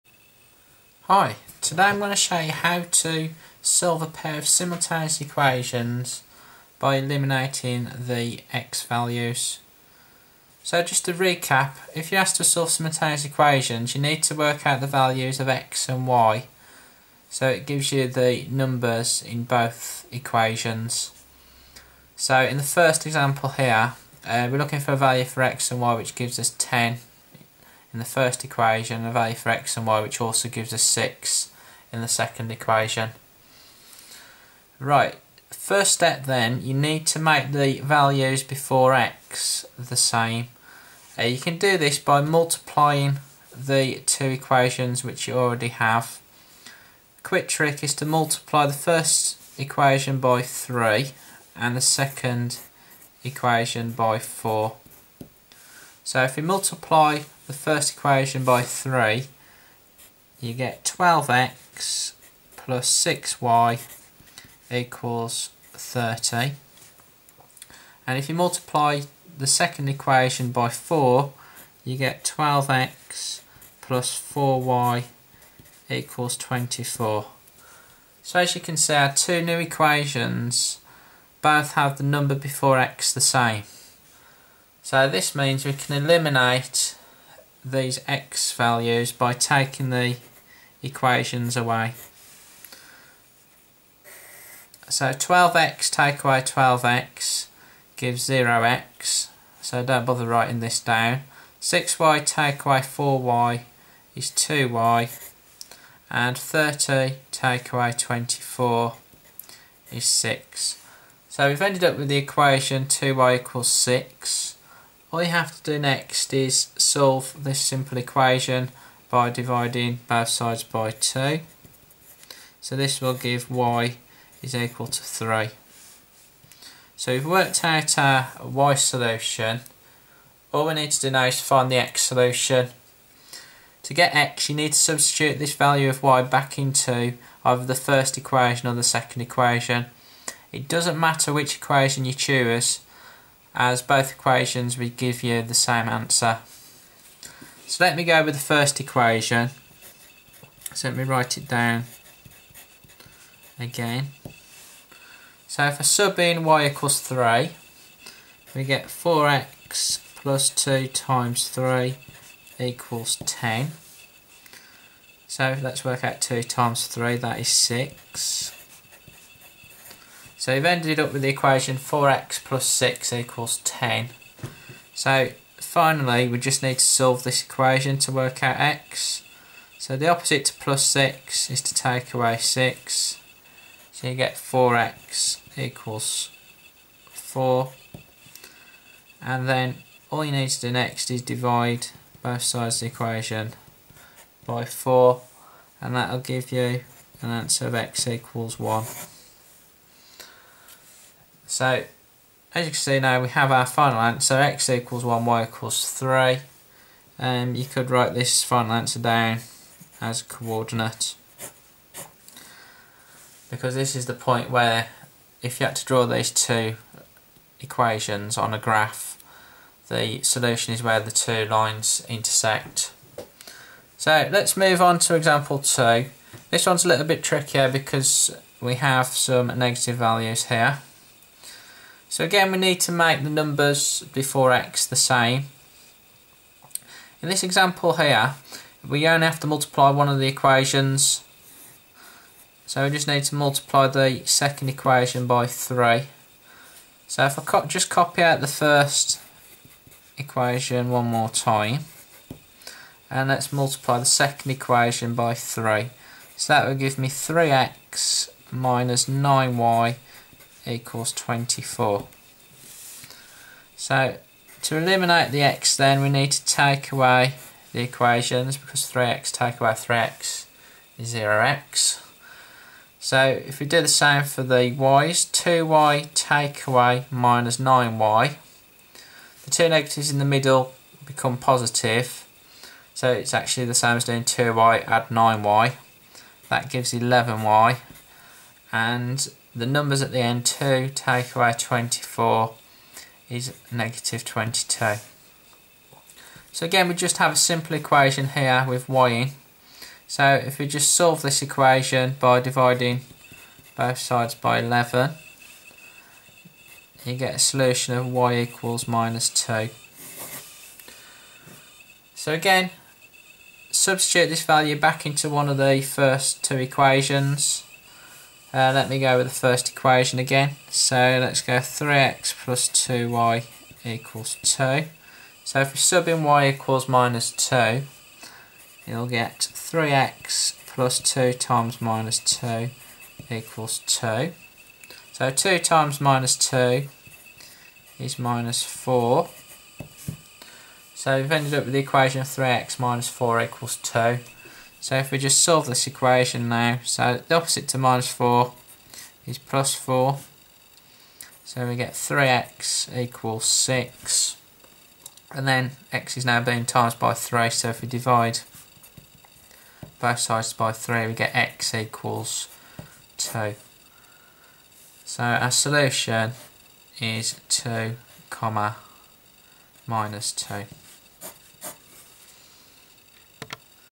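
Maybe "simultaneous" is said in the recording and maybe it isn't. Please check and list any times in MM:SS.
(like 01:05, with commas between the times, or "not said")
00:04, 00:12.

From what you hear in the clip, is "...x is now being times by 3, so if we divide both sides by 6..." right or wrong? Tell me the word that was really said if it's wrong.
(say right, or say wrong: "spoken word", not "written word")
wrong: "3", not "6".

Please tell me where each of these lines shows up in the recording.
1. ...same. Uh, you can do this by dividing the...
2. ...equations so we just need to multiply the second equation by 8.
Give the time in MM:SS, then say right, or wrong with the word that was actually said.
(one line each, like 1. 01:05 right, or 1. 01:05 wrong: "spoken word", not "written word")
1. 00:39 wrong: "multiplying", not "dividing"
2. 04:00 wrong: "3", not "8".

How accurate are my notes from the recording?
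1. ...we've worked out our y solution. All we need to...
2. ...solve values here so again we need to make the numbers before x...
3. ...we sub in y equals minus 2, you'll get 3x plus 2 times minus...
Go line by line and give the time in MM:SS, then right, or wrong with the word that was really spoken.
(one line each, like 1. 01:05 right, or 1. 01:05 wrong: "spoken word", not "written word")
1. 02:07 right
2. 03:49 wrong: "negative", not "solve"
3. 05:25 right.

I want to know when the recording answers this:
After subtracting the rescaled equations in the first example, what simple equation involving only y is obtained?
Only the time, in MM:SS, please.
01:52.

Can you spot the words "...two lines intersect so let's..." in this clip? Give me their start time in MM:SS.
03:41.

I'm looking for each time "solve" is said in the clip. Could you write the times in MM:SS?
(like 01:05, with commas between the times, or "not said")
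00:03, 00:12, 01:56, 02:56, 05:00, 05:45.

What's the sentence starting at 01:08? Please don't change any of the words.
And if you multiply the second equation by 4, you get 12x plus 4y equals 24.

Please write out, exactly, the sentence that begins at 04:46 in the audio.
That gives 11y and the numbers at the end 2 take away 24 is negative 22.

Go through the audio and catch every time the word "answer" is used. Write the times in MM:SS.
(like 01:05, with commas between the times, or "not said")
02:25, 03:17, 03:23, 03:28.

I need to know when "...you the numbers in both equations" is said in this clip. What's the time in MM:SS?
00:17.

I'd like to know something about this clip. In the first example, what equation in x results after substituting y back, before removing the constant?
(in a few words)
4x + 6 = 10.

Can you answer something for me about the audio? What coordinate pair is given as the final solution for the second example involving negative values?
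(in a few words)
(2, -2).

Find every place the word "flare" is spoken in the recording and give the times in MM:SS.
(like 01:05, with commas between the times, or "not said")
not said.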